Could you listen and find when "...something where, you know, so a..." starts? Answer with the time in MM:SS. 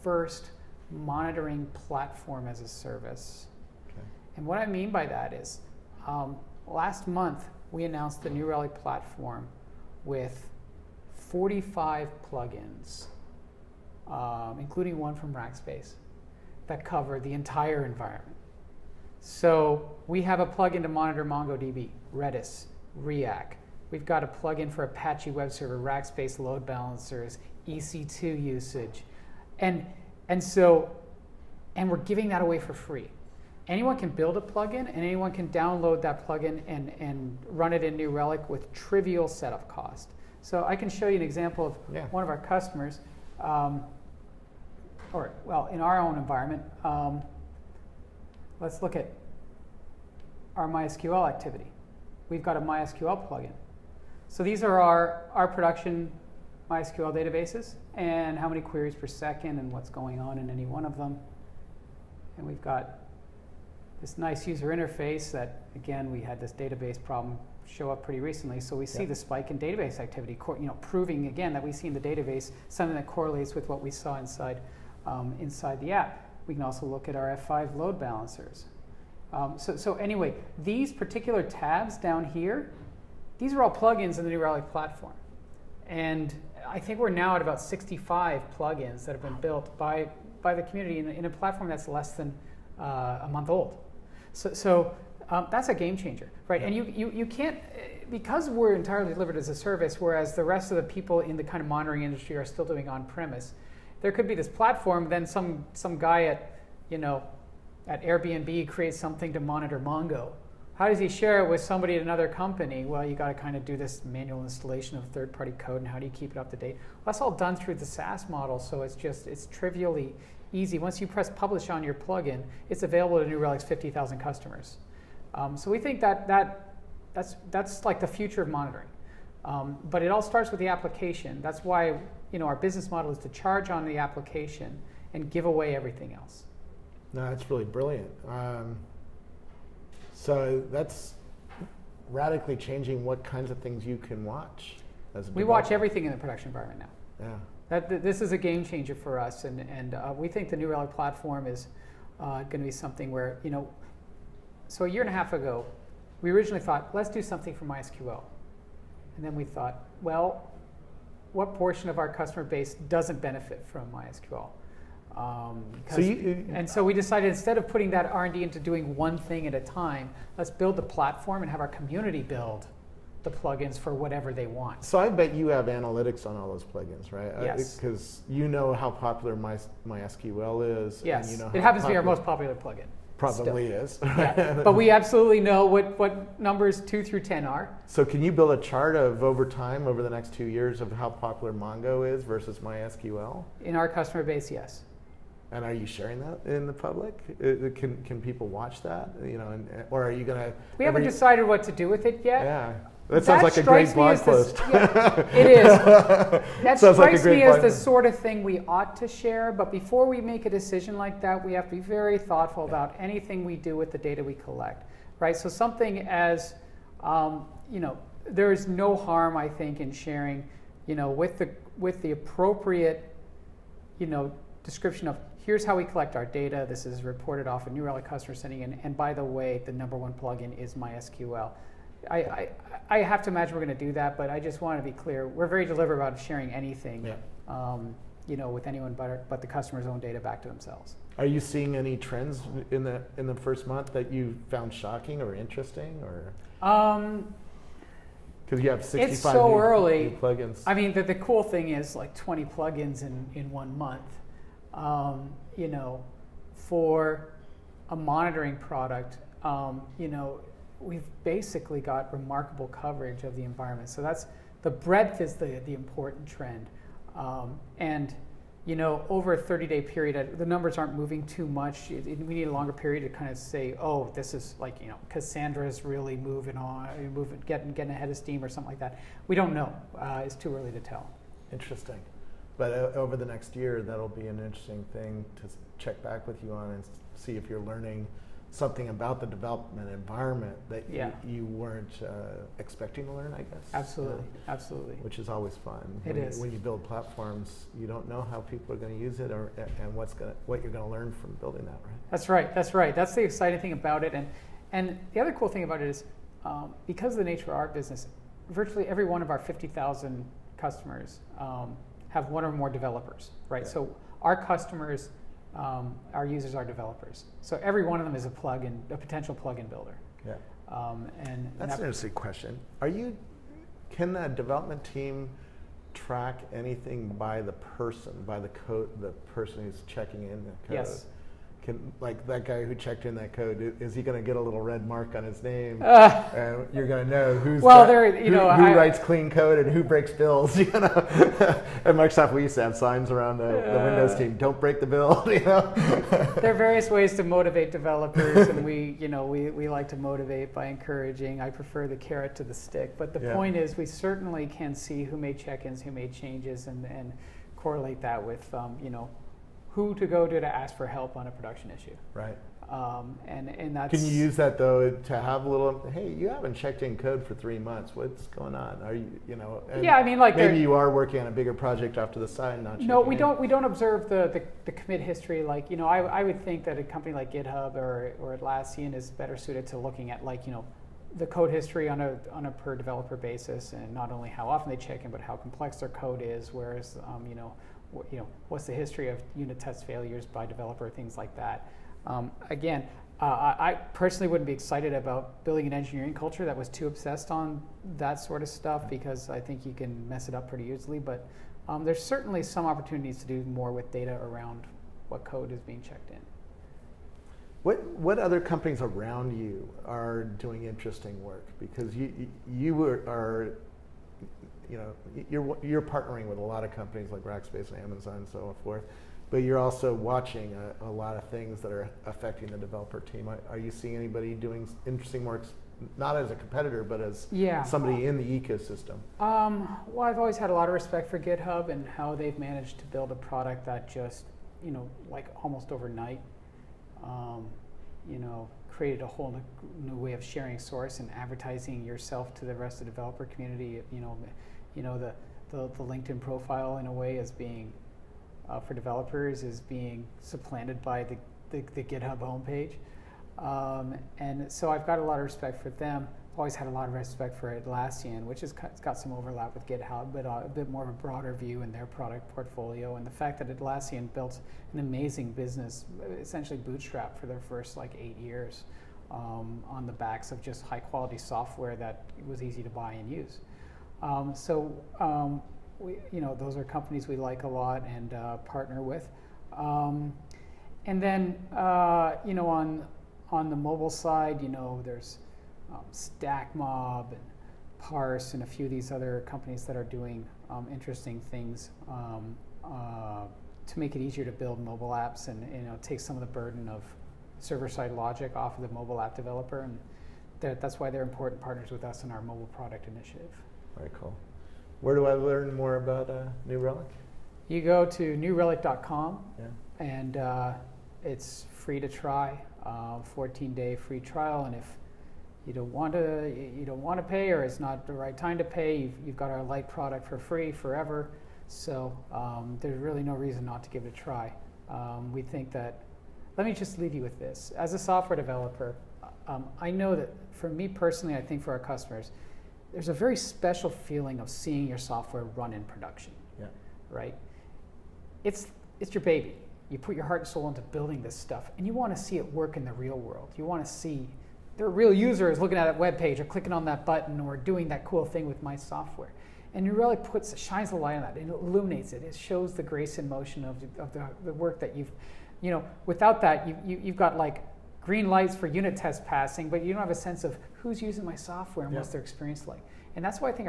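02:32.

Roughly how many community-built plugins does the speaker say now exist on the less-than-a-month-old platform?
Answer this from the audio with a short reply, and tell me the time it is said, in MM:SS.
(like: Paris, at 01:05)
65, at 01:27.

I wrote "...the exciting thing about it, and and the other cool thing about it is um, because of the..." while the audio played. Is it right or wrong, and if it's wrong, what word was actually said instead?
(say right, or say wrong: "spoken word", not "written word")
right.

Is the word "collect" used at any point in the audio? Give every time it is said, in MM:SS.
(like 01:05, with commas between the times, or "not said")
03:34, 03:45.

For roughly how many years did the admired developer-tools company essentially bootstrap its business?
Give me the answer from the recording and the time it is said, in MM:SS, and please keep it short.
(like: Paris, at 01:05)
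8, at 07:47.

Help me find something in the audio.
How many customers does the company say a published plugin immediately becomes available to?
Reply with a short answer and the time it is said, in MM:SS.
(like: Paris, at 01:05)
50,000, at 02:03.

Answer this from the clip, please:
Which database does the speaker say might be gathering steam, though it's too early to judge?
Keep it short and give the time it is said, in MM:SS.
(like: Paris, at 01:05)
Cassandra, at 04:35.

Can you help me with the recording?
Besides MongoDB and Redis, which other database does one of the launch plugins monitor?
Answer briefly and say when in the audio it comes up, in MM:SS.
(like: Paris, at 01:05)
Riak, at 00:23.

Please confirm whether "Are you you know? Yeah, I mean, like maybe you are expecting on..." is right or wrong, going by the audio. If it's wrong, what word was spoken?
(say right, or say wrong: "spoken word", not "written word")
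wrong: "working", not "expecting".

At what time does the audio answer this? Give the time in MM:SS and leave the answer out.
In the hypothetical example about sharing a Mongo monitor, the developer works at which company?
01:48.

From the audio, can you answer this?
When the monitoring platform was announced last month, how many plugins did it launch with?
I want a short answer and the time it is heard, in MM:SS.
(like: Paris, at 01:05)
45, at 00:11.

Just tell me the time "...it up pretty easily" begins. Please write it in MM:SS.
06:40.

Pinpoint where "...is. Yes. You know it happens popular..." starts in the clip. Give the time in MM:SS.
03:00.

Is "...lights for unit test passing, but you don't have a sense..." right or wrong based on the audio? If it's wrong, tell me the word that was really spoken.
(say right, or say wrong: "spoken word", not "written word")
right.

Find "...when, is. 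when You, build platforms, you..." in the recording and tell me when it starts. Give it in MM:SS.
04:56.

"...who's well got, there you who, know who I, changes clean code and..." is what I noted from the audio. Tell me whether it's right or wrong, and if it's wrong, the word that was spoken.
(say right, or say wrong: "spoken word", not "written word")
wrong: "writes", not "changes".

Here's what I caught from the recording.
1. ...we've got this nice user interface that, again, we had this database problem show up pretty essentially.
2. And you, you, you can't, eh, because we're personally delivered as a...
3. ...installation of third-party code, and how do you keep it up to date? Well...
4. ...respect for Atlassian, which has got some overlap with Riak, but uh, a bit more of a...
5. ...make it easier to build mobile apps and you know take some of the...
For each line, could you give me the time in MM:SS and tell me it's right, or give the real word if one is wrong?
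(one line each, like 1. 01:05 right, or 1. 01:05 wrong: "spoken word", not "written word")
1. 01:02 wrong: "recently", not "essentially"
2. 01:36 wrong: "entirely", not "personally"
3. 01:54 right
4. 07:36 wrong: "GitHub", not "Riak"
5. 08:13 right.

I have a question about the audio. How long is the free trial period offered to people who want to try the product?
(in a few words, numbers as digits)
14 days.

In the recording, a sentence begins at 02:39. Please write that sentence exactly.
And then we thought, well, what portion of our customer base doesn't benefit from MySQL?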